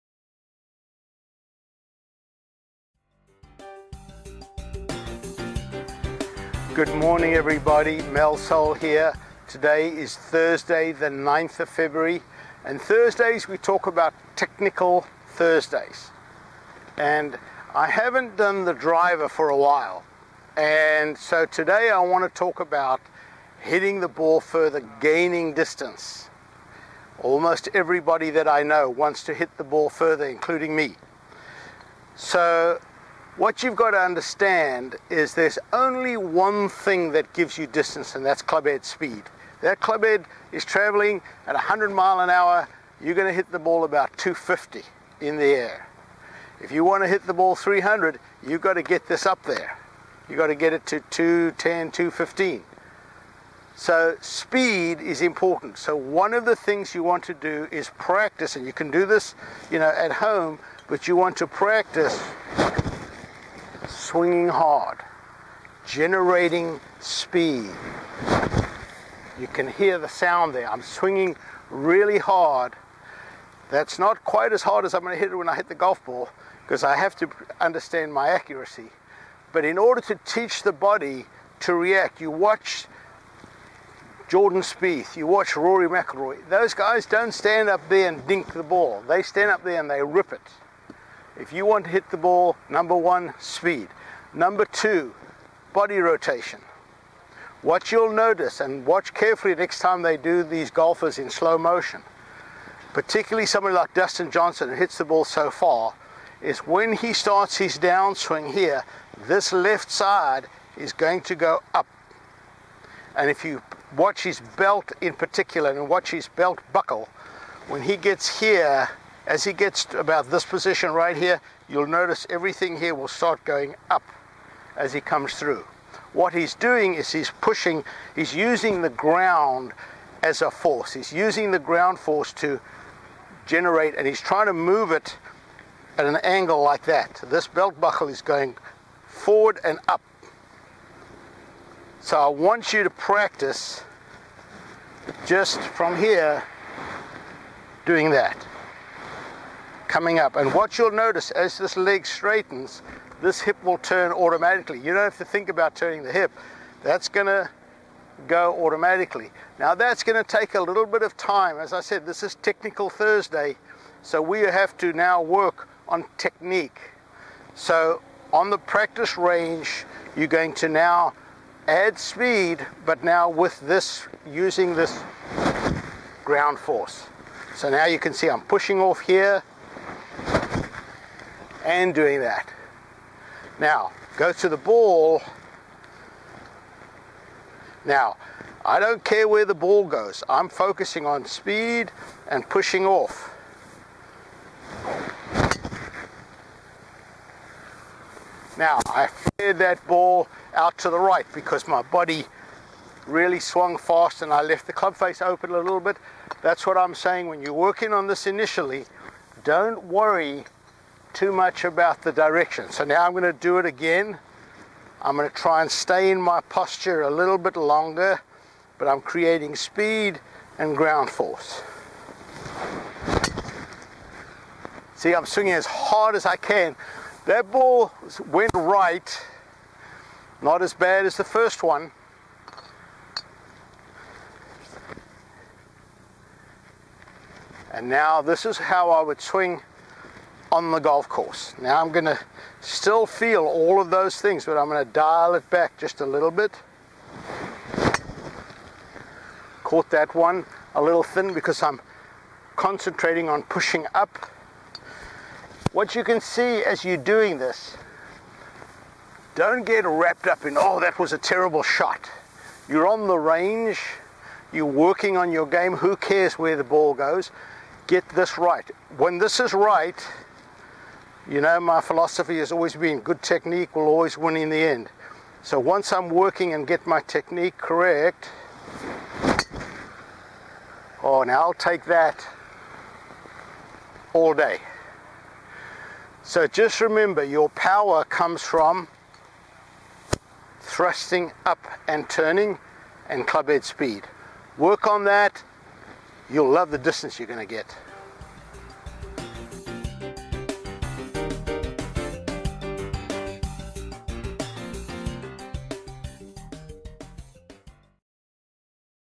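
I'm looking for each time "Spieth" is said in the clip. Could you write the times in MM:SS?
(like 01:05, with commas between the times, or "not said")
01:24.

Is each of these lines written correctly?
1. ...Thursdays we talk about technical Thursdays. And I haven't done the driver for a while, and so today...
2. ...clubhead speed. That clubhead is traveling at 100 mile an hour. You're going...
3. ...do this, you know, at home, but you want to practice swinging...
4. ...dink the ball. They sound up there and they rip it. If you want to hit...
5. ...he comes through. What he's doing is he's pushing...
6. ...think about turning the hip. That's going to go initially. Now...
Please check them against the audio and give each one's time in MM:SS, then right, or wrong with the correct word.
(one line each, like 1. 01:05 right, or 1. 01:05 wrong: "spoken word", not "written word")
1. 00:12 right
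2. 00:38 right
3. 00:58 right
4. 01:28 wrong: "stand", not "sound"
5. 02:04 right
6. 02:35 wrong: "automatically", not "initially".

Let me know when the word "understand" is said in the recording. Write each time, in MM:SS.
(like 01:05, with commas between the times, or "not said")
00:33, 01:17.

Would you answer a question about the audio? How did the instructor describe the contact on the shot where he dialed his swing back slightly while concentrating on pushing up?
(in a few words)
A little thin.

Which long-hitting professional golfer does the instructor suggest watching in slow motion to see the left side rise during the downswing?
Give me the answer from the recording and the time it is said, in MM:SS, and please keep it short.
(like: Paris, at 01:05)
Dustin Johnson, at 01:43.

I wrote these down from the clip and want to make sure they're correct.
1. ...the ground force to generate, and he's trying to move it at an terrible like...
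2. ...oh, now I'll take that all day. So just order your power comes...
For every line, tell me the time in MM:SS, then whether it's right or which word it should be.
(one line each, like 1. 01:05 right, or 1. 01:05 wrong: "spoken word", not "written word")
1. 02:11 wrong: "angle", not "terrible"
2. 04:41 wrong: "remember", not "order".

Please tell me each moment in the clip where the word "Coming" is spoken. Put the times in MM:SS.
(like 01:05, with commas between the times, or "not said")
02:29.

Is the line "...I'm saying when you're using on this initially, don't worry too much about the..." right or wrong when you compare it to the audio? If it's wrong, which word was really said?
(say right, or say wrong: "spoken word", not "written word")
wrong: "working", not "using".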